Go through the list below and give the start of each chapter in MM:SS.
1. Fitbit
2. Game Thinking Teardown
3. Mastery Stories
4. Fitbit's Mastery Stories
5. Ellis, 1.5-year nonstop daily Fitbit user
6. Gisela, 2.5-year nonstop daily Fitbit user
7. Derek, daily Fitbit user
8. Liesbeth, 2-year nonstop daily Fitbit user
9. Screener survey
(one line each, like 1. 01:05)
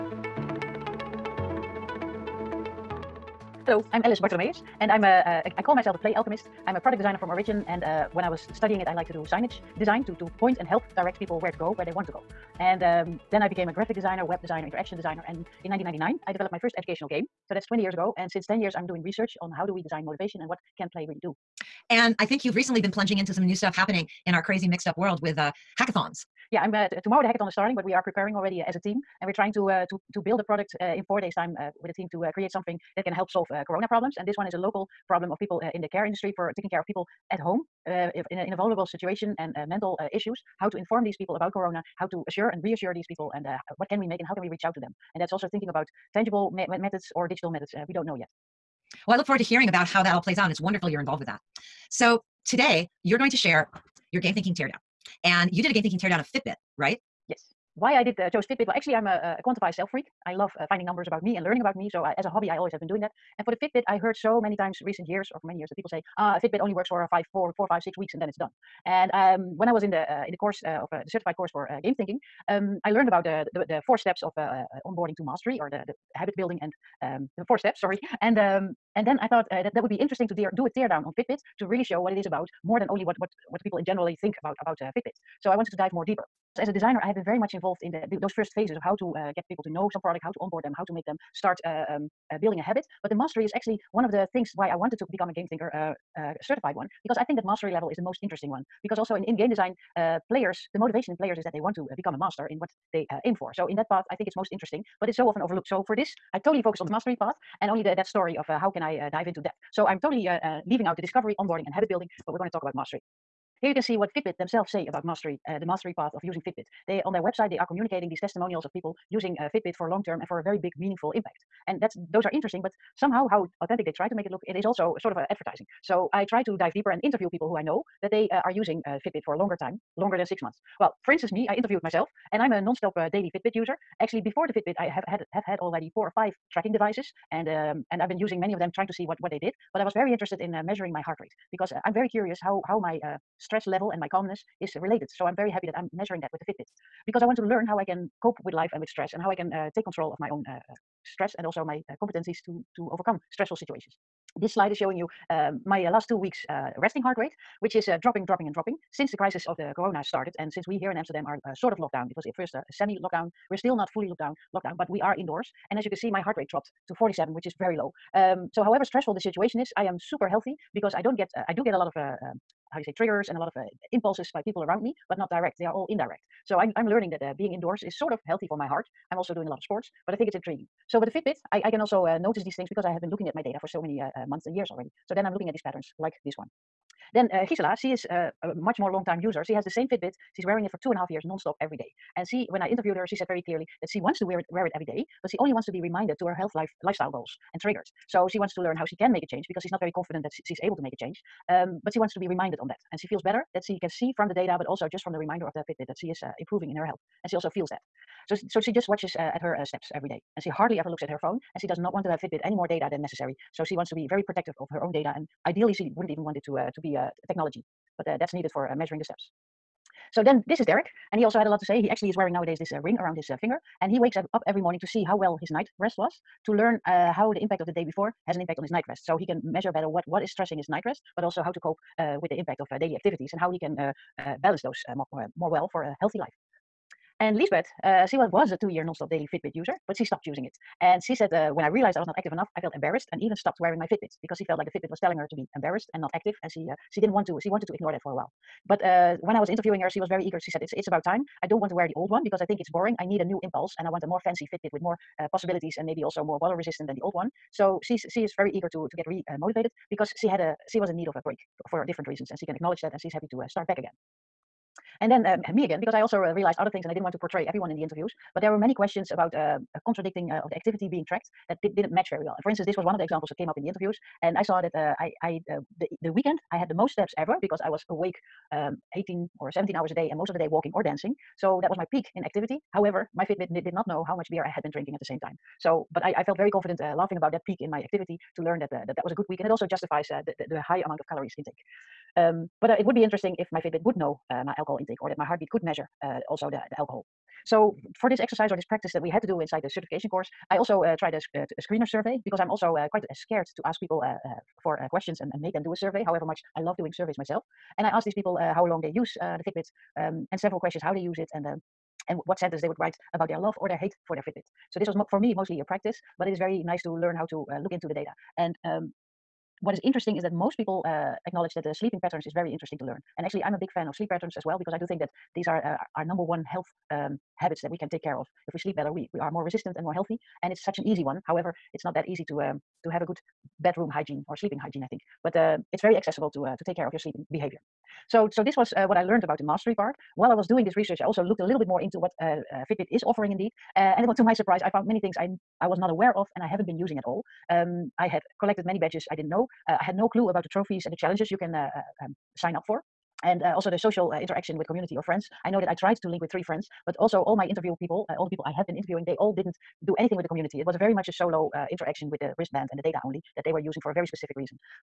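1. 00:58
2. 01:28
3. 01:47
4. 01:54
5. 02:10
6. 03:07
7. 03:41
8. 03:57
9. 04:57.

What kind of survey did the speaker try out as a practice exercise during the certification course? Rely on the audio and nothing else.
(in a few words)
screener survey.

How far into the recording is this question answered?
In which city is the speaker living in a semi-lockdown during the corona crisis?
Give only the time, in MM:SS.
02:40.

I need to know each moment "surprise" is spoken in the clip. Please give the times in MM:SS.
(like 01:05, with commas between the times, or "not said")
05:44.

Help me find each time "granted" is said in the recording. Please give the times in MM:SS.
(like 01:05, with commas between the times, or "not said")
not said.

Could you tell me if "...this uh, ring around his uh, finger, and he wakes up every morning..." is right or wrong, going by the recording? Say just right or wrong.
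right.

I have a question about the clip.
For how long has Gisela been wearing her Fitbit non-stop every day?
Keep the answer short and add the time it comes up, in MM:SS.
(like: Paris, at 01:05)
2 and a half years, at 03:10.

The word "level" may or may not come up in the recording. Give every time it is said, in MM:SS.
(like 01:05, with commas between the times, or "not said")
01:37, 02:23.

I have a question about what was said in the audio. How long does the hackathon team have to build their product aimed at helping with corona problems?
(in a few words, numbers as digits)
4 days.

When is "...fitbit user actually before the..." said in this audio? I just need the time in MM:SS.
02:13.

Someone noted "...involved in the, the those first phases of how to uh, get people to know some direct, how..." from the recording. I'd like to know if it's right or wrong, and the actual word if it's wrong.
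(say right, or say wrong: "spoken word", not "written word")
wrong: "product", not "direct".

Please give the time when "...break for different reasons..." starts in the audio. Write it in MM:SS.
04:21.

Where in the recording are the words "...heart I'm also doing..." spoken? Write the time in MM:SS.
02:58.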